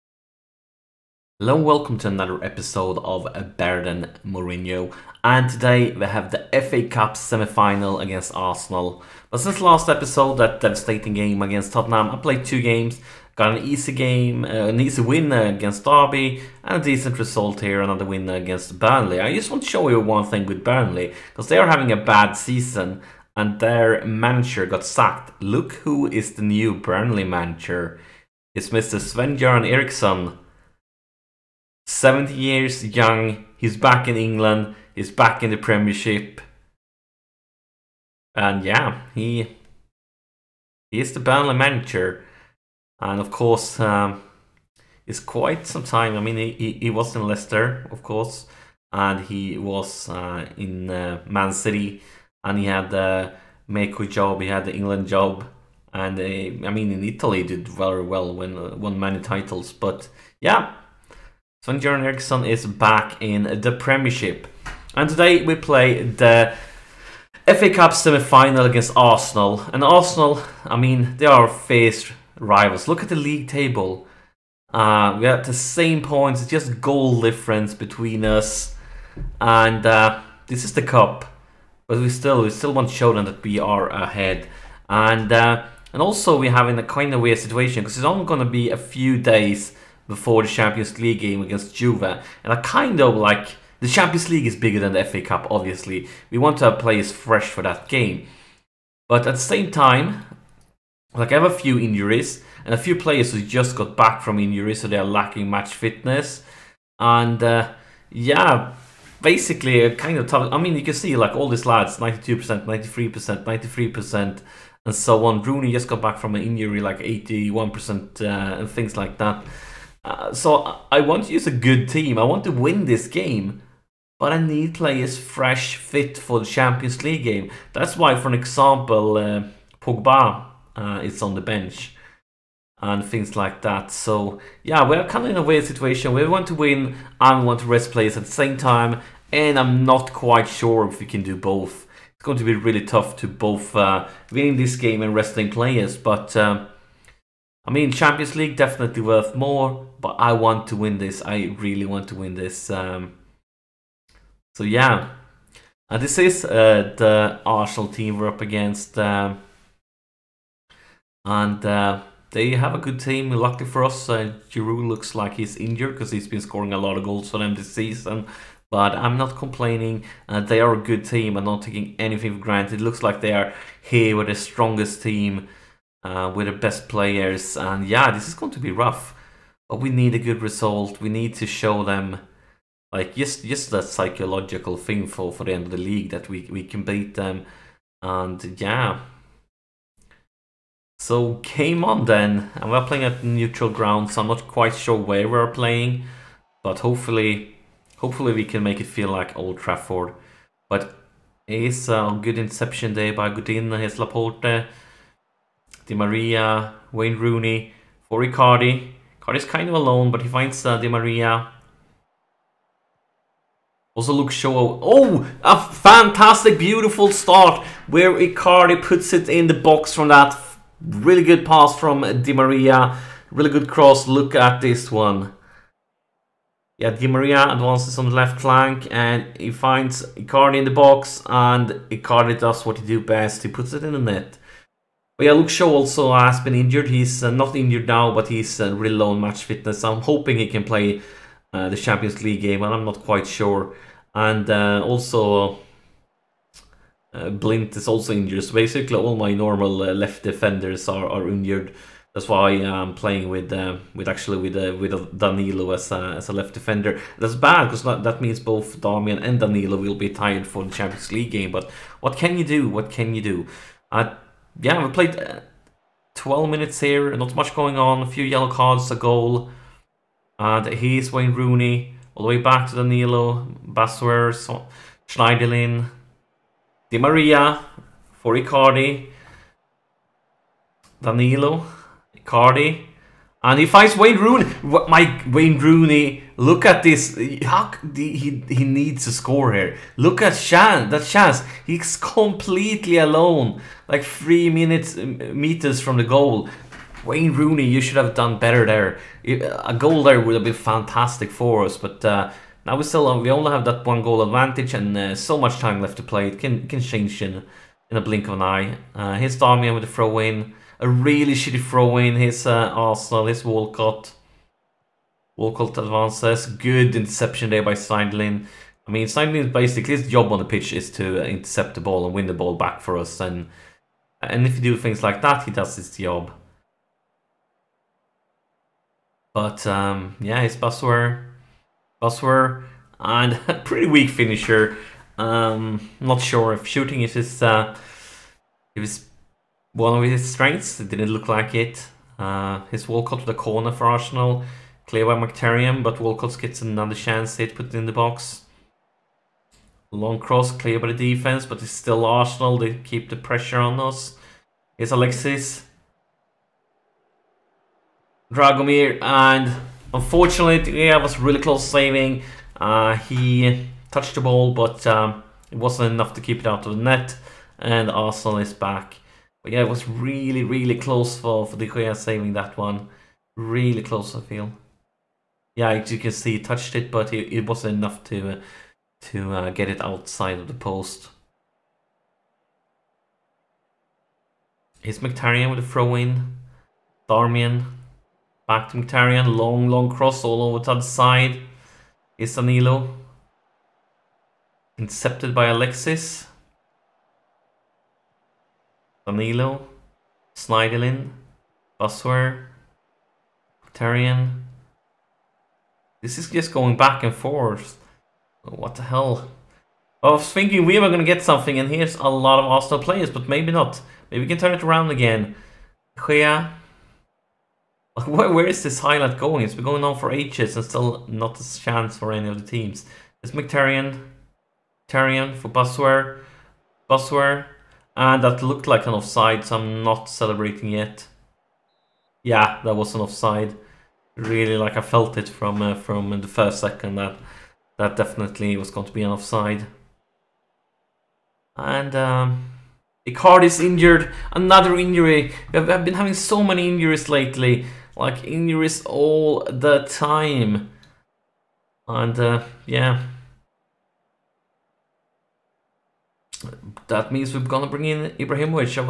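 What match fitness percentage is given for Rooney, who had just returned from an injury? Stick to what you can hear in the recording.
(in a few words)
81%.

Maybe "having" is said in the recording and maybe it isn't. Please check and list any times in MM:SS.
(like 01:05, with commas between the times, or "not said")
00:21, 07:25.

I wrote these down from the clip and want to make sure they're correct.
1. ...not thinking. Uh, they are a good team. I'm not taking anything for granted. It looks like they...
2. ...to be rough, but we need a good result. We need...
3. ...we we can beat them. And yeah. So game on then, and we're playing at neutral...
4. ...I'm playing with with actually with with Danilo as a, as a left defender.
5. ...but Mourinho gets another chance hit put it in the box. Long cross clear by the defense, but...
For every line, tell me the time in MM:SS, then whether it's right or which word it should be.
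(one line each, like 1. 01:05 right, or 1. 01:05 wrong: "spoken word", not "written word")
1. 02:49 wrong: "complaining", not "thinking"
2. 02:58 right
3. 03:06 right
4. 04:12 right
5. 05:45 wrong: "Walcott", not "Mourinho".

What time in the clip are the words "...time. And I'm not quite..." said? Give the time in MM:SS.
02:18.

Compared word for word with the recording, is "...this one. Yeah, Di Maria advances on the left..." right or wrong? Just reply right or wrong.
right.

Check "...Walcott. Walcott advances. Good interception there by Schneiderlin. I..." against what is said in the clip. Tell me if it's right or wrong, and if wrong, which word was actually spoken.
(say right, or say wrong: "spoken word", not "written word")
right.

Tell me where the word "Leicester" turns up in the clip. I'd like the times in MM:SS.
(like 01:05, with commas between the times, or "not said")
00:47.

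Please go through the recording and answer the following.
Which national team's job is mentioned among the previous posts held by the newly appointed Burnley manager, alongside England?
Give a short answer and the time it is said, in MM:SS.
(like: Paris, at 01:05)
Mexico, at 00:53.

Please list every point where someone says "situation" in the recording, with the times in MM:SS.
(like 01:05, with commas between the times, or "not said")
01:27, 02:15.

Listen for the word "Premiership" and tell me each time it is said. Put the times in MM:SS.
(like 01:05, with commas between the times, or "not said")
00:35, 01:03.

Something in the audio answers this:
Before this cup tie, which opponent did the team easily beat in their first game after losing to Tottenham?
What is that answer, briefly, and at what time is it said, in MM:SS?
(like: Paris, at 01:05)
Derby, at 00:15.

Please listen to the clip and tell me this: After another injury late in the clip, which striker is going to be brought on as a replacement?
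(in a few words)
Ibrahimovic.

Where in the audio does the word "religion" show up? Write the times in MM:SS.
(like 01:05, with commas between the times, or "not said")
not said.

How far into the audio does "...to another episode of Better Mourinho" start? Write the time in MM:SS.
00:01.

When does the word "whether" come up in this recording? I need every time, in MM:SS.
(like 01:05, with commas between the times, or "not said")
not said.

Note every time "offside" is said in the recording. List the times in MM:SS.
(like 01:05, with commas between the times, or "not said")
07:08, 07:12, 07:19.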